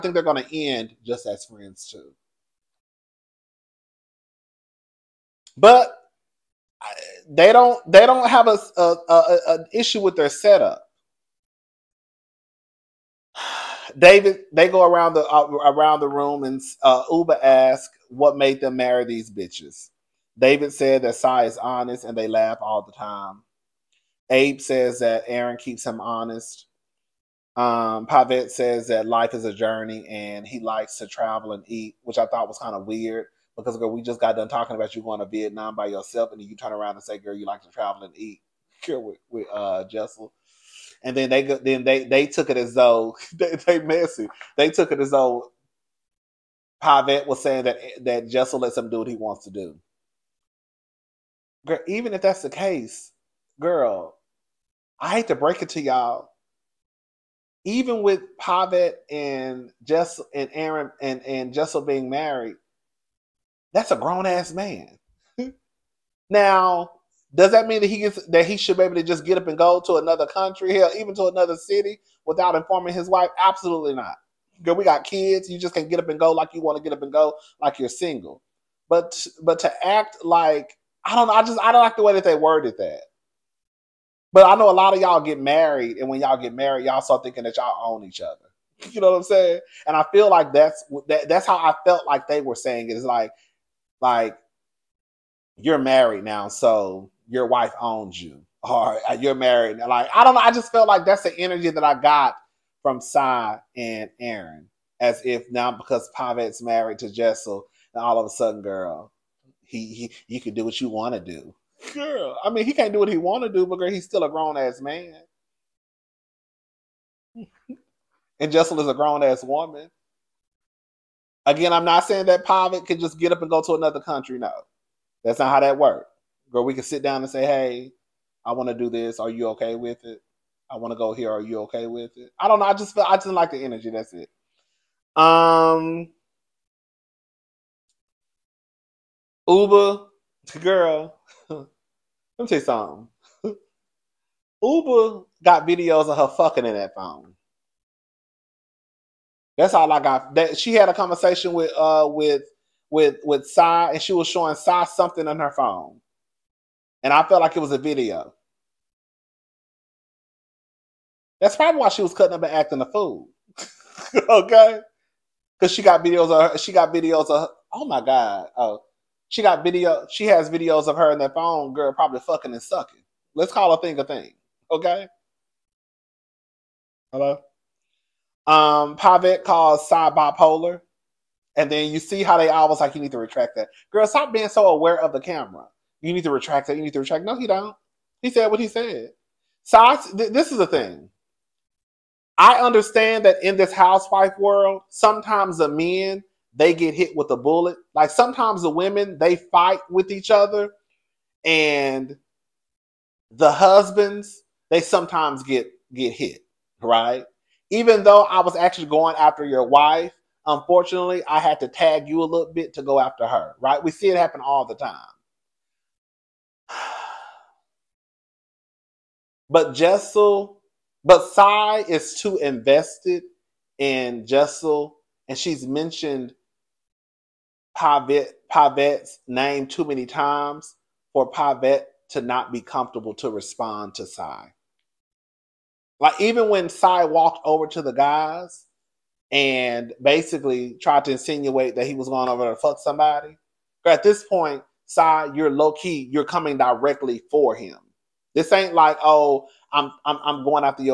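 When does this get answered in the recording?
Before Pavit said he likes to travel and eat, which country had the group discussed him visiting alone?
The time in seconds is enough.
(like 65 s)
35 s.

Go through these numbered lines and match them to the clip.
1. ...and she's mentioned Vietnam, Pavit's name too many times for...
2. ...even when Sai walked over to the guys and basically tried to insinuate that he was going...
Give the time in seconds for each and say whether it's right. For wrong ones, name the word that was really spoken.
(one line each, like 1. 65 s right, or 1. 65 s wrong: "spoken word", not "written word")
1. 225 s wrong: "Pavit", not "Vietnam"
2. 236 s right.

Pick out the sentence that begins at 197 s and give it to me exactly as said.
Like sometimes the women they fight with each other, and the husbands they sometimes get get hit, right?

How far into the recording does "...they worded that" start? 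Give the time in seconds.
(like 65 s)
82 s.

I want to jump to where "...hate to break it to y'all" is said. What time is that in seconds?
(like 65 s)
55 s.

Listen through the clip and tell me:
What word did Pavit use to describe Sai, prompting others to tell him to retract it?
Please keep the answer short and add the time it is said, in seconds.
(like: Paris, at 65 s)
Bipolar, at 180 s.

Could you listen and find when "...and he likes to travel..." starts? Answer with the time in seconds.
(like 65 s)
30 s.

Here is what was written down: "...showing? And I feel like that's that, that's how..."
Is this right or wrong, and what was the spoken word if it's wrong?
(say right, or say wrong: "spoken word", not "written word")
wrong: "saying", not "showing".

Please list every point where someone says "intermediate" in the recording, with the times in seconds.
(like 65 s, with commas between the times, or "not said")
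not said.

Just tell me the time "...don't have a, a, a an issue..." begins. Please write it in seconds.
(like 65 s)
8 s.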